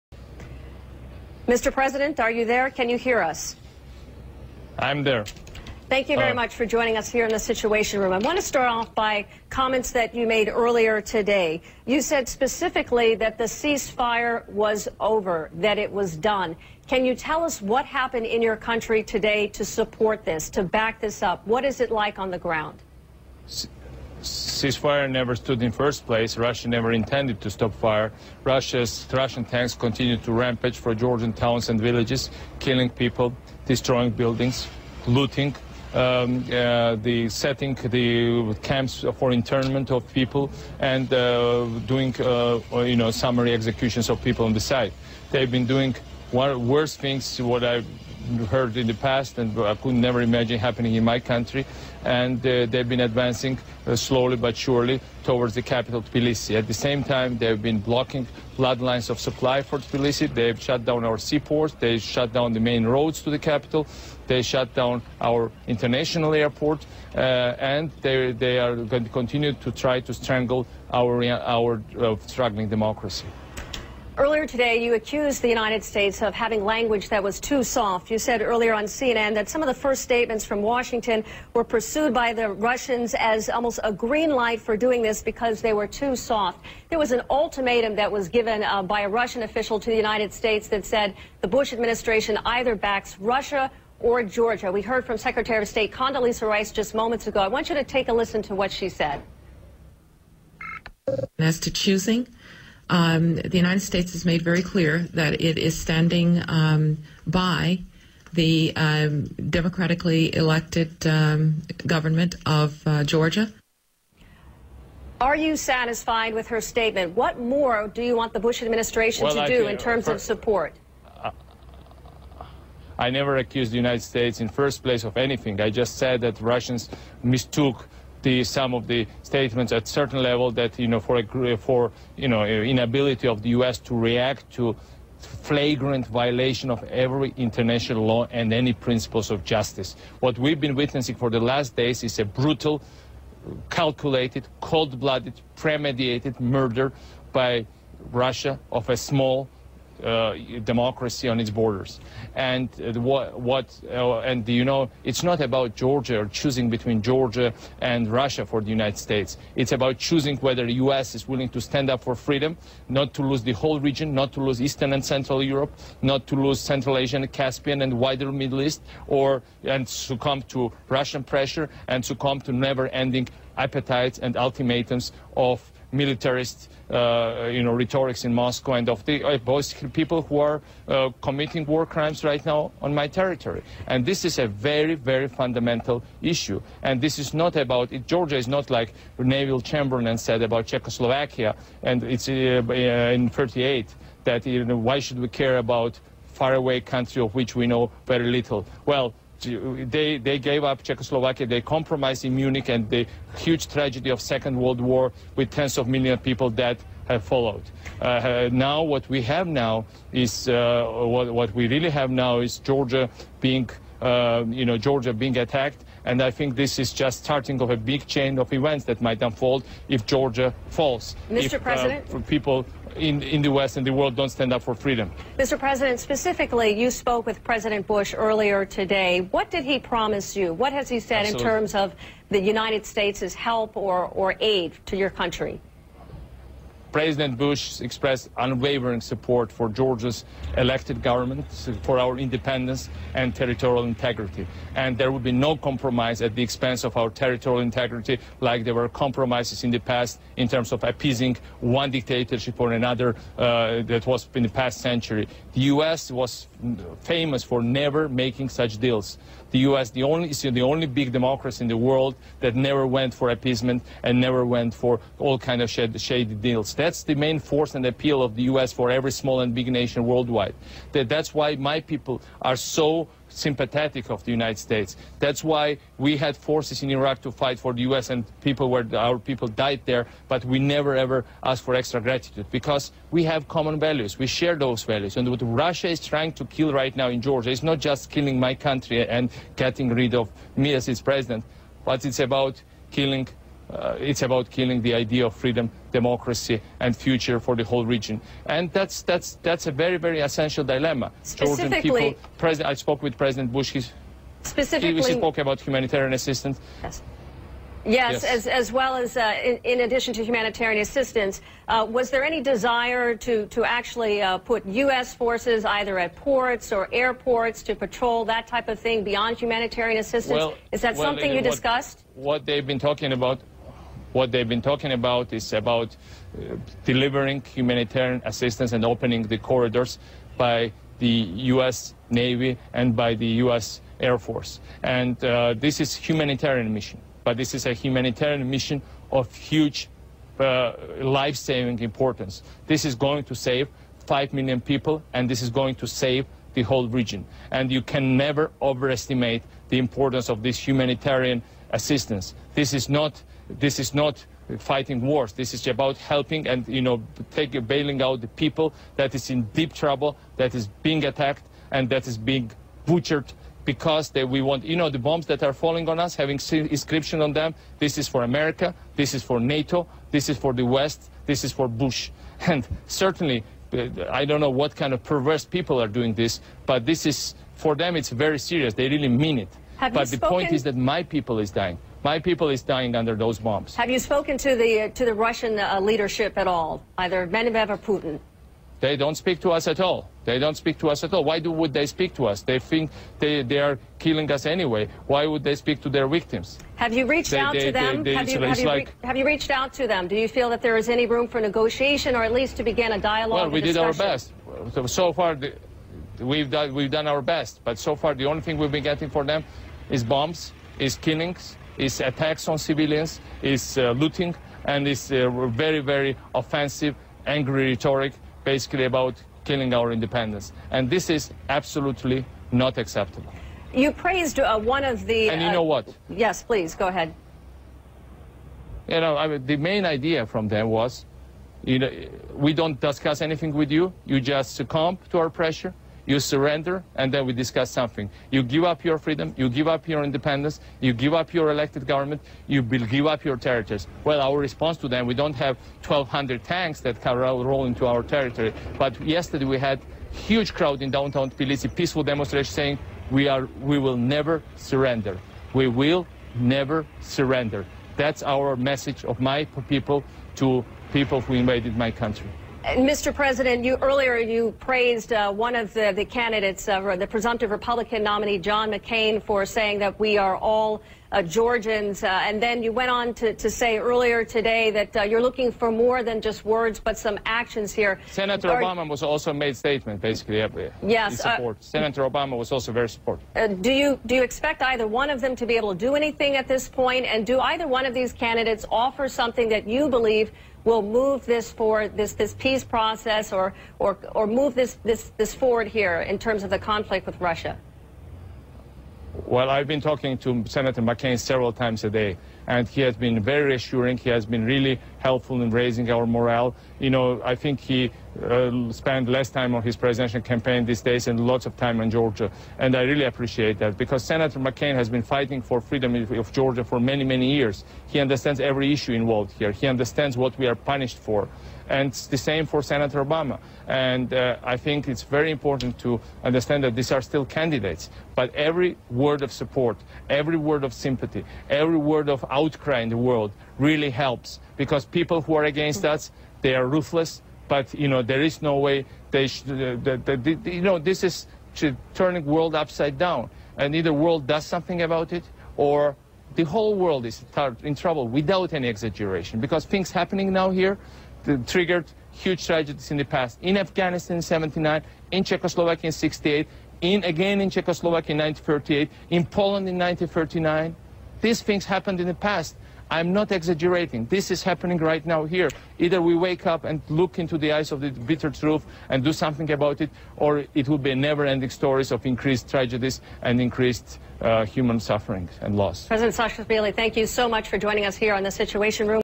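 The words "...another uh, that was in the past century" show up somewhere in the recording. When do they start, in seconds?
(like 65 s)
252 s.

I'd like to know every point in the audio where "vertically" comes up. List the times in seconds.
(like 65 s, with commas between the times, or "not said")
not said.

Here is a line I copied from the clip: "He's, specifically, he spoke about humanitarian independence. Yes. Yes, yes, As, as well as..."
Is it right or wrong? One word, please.
wrong.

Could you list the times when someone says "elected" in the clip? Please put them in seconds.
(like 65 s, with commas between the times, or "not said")
110 s, 240 s, 441 s.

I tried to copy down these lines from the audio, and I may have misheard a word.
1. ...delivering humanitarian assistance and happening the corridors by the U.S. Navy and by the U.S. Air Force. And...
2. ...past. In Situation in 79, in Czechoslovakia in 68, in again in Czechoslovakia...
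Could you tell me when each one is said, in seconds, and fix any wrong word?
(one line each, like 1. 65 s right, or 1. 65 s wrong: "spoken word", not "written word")
1. 326 s wrong: "opening", not "happening"
2. 553 s wrong: "Afghanistan", not "Situation".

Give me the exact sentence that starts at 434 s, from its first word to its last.
You just succumb to our pressure you surrender, and then we discuss something.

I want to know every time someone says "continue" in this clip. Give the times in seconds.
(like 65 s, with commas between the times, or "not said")
29 s, 69 s.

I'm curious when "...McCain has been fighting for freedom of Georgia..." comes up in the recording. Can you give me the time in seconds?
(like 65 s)
514 s.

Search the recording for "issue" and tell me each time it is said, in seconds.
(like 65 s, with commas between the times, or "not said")
186 s, 518 s.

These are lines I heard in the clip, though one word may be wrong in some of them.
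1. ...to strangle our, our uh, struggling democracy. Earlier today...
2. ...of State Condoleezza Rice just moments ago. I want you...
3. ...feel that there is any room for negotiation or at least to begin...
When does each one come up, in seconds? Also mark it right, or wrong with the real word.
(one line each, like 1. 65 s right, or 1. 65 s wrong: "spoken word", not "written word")
1. 69 s right
2. 95 s right
3. 400 s right.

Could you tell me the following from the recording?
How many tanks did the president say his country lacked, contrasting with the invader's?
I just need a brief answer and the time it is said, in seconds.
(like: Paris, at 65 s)
1,200, at 445 s.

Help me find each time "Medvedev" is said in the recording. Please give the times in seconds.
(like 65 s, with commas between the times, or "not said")
387 s.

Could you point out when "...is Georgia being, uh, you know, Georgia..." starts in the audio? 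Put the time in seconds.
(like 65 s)
212 s.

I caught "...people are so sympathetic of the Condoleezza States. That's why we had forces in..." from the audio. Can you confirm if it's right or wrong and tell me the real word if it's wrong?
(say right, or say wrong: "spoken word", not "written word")
wrong: "United", not "Condoleezza".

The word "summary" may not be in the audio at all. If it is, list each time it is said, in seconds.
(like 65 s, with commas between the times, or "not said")
43 s.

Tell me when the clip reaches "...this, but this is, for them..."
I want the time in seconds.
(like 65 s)
376 s.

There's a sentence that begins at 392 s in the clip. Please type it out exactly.
They think they, they are killing us anyway.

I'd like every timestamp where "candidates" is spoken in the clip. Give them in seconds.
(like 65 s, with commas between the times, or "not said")
466 s, 488 s, 527 s.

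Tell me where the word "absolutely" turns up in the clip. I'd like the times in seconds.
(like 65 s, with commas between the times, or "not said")
231 s, 421 s.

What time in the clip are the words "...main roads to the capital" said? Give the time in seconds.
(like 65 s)
62 s.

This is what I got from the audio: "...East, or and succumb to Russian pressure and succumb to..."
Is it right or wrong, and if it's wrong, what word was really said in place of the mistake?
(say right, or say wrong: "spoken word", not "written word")
right.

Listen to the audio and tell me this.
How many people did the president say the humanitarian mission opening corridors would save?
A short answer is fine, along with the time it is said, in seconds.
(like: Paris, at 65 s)
5 million, at 344 s.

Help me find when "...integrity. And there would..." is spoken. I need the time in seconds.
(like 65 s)
243 s.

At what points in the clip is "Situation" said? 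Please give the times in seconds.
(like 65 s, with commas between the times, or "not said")
7 s, 578 s.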